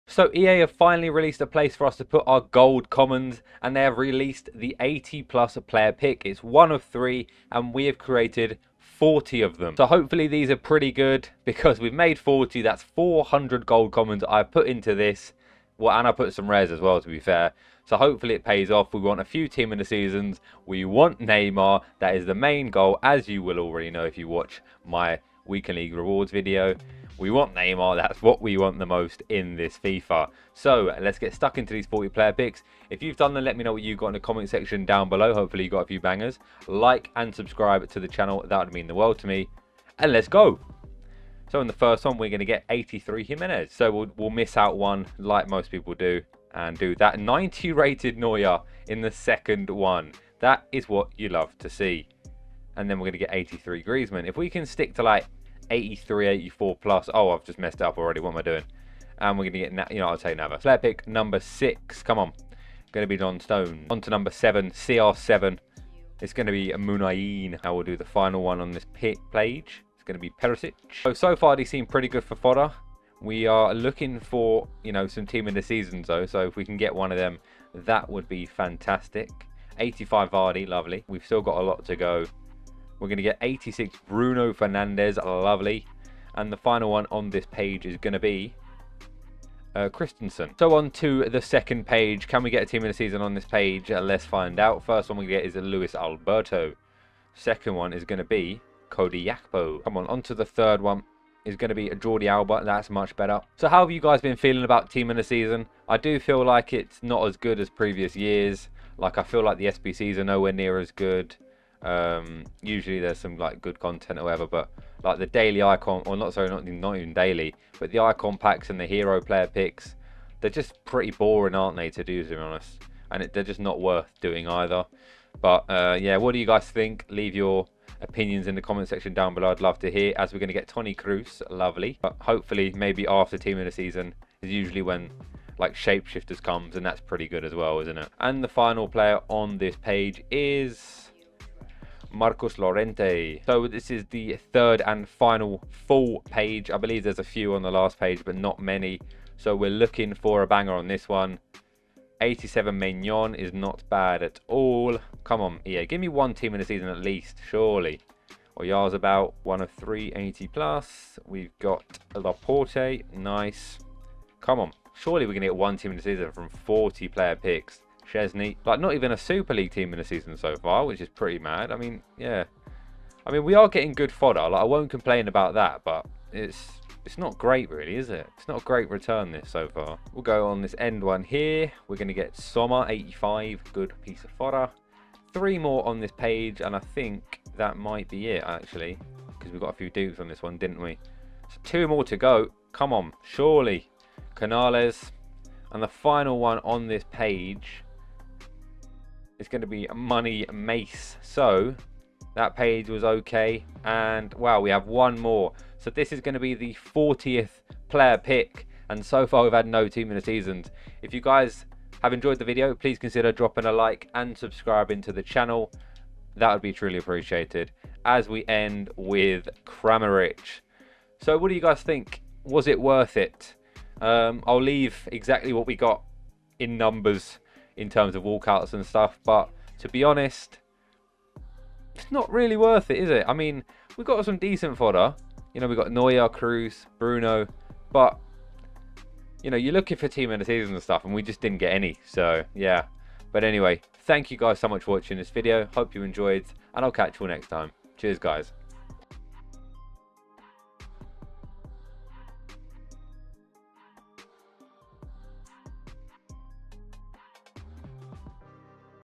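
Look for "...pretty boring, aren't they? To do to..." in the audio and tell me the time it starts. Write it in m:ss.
2:00.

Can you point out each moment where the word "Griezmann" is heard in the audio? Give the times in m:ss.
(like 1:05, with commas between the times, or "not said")
0:53.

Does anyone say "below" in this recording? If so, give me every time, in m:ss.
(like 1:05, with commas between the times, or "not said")
0:35, 2:09.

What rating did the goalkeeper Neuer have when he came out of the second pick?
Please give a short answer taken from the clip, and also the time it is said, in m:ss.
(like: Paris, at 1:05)
90, at 0:47.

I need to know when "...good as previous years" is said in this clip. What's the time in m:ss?
1:47.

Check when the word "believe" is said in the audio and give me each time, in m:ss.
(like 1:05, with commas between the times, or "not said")
2:26.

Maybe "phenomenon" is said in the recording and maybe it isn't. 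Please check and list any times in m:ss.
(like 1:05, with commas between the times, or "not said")
not said.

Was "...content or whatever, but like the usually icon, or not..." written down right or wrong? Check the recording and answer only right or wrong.
wrong.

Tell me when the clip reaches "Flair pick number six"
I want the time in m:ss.
1:00.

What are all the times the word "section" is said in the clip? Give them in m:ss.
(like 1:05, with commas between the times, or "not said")
0:34, 2:08.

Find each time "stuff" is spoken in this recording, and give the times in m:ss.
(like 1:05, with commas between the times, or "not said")
3:48, 4:00.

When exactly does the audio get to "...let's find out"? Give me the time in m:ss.
1:34.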